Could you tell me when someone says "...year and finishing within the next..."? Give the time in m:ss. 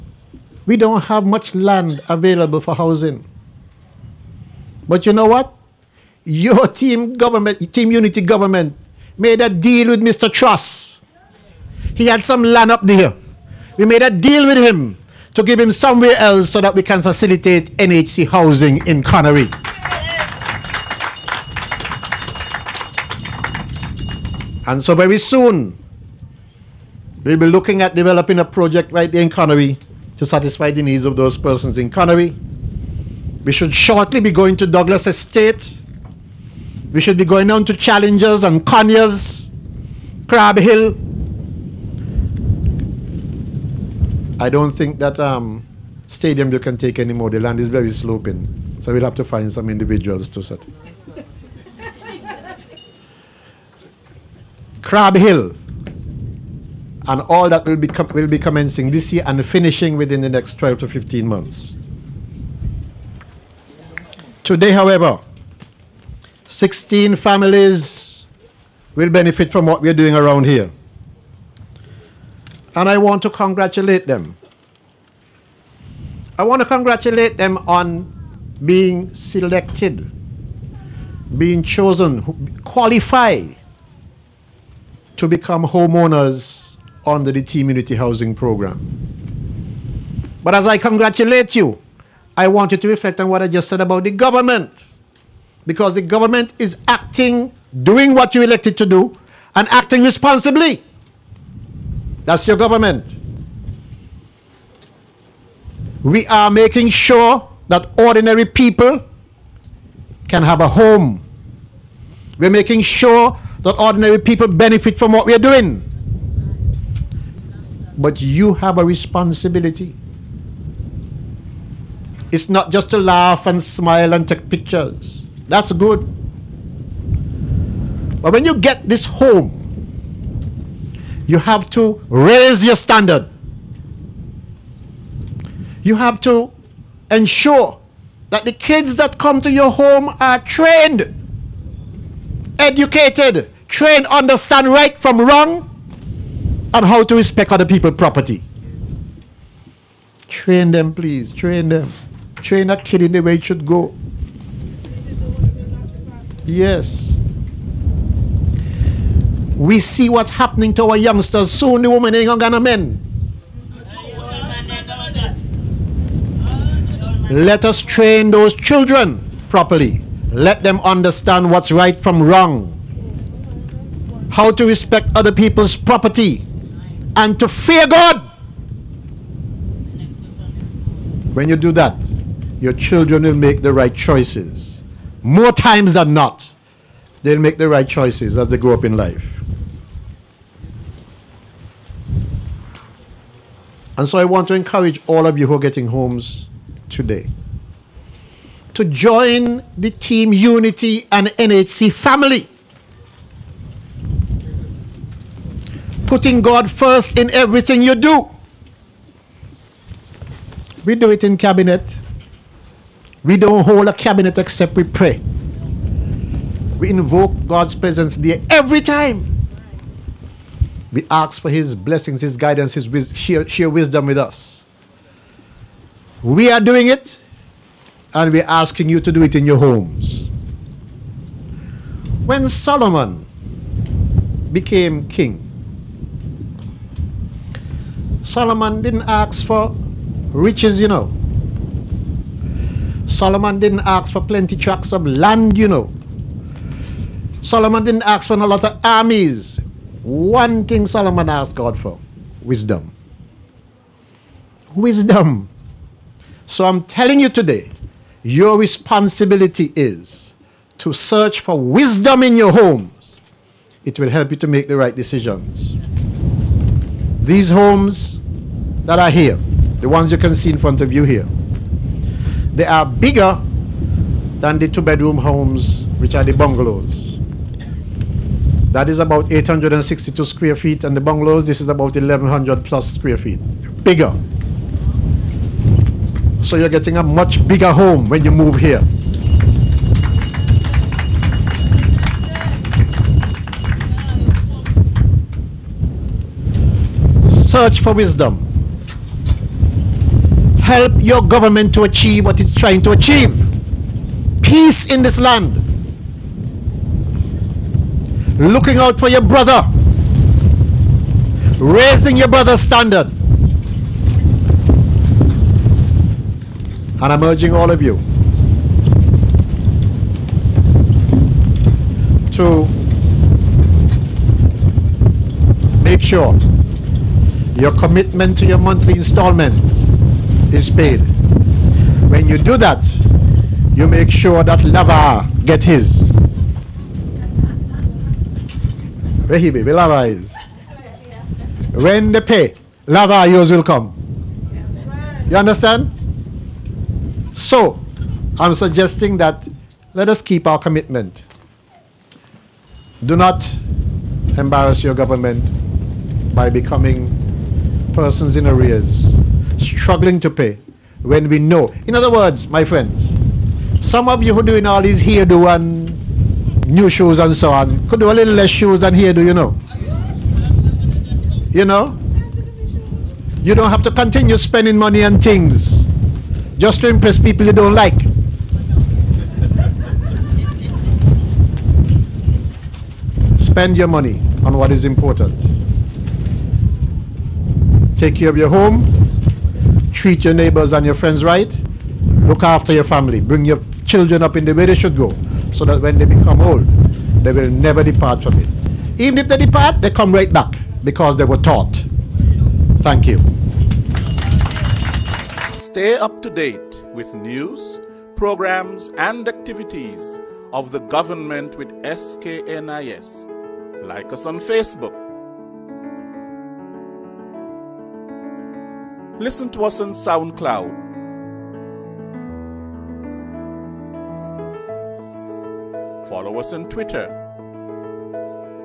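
0:59.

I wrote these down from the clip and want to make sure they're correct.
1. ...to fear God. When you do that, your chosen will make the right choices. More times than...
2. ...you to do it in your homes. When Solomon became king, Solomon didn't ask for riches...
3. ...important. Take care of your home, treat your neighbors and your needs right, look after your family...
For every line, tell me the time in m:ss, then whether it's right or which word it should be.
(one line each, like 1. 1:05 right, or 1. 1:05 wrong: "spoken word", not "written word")
1. 2:57 wrong: "children", not "chosen"
2. 3:48 right
3. 6:24 wrong: "friends", not "needs".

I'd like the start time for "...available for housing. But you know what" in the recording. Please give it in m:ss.
0:02.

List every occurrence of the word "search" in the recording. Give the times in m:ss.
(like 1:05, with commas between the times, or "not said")
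4:20, 4:57.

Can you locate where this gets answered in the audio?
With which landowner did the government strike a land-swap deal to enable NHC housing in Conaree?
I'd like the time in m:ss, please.
0:10.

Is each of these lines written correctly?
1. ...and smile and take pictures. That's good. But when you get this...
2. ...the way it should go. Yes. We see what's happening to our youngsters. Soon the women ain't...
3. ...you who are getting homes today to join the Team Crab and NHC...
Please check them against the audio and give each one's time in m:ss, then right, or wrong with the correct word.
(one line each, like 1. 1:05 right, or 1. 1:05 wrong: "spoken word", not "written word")
1. 2:03 right
2. 2:33 right
3. 3:15 wrong: "Unity", not "Crab".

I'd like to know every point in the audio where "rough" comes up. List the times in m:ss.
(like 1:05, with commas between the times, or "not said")
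not said.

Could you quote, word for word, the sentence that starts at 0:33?
We should shortly be going to Douglas Estate.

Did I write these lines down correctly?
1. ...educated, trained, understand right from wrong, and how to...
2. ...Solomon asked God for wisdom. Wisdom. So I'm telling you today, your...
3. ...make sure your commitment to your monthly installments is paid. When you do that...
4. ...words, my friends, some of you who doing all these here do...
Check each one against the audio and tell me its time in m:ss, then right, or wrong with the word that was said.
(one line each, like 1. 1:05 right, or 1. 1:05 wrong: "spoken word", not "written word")
1. 2:22 right
2. 4:10 right
3. 5:25 right
4. 6:02 right.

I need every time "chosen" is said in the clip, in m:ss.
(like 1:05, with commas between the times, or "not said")
1:21.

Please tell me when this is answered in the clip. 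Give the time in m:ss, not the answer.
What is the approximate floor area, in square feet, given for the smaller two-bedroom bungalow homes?
4:39.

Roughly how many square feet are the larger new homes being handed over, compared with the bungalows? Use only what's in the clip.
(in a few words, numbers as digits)
1100 plus.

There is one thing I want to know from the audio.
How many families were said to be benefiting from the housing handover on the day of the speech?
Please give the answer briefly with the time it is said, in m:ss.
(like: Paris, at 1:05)
16, at 1:06.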